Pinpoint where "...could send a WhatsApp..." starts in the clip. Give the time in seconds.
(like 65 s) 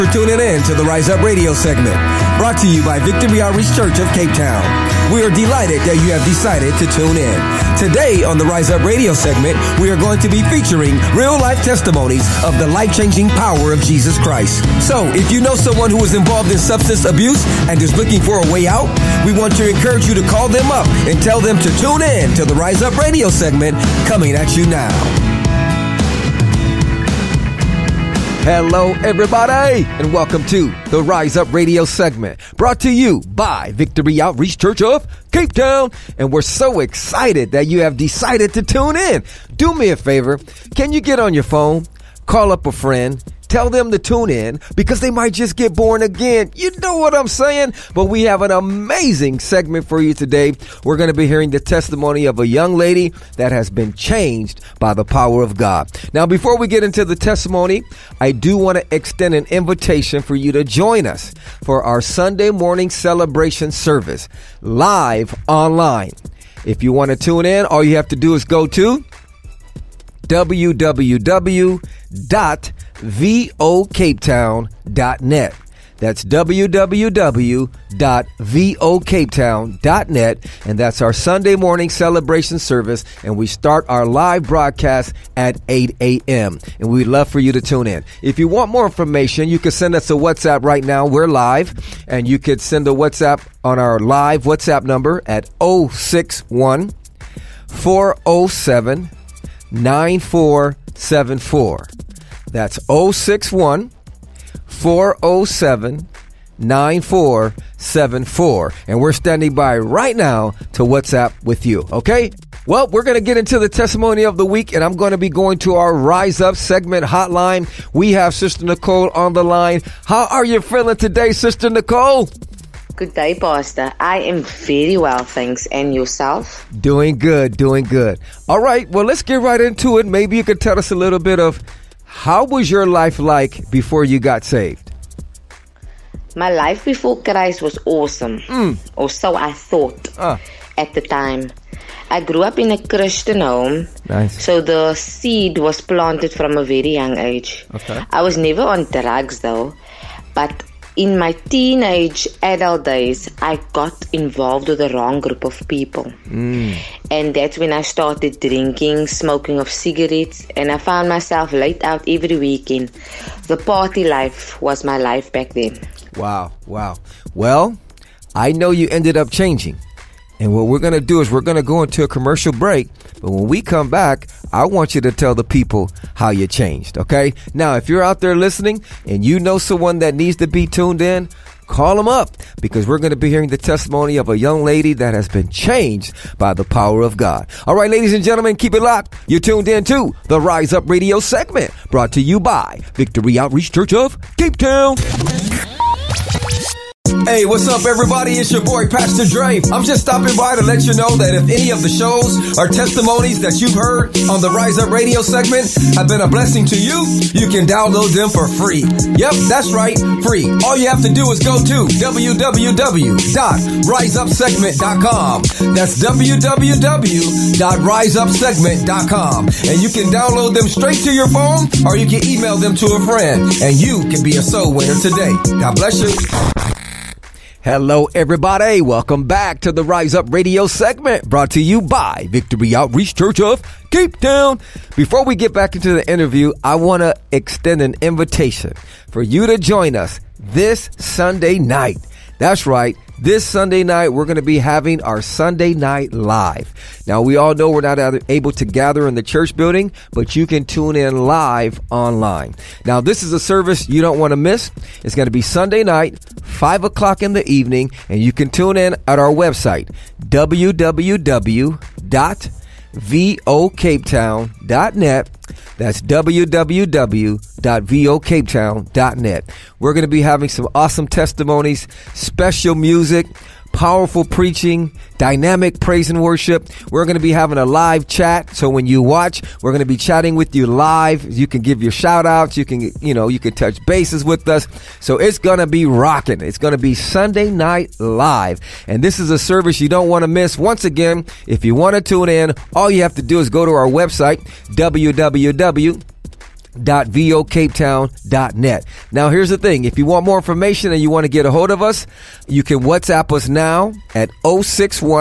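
92 s.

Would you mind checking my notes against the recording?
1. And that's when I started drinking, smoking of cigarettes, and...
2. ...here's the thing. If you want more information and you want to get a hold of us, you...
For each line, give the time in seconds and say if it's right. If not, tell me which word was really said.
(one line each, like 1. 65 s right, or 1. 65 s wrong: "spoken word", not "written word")
1. 157 s right
2. 299 s right.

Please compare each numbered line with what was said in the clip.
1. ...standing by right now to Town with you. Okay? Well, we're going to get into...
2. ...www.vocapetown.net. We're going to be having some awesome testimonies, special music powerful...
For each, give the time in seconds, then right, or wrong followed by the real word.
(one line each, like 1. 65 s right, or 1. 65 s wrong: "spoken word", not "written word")
1. 109 s wrong: "WhatsApp", not "Town"
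2. 266 s right.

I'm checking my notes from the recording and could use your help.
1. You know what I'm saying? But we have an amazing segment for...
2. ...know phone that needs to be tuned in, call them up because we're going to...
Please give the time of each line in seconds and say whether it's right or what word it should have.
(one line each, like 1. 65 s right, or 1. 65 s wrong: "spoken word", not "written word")
1. 46 s right
2. 179 s wrong: "someone", not "phone".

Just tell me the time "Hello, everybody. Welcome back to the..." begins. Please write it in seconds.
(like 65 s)
227 s.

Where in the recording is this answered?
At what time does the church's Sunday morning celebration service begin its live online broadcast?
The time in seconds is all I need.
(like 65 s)
85 s.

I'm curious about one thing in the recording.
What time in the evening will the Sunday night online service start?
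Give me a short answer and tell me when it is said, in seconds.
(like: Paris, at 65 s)
5 o'clock, at 256 s.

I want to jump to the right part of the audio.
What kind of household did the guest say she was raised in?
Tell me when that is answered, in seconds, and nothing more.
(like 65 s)
142 s.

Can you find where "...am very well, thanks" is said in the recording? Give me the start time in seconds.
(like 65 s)
124 s.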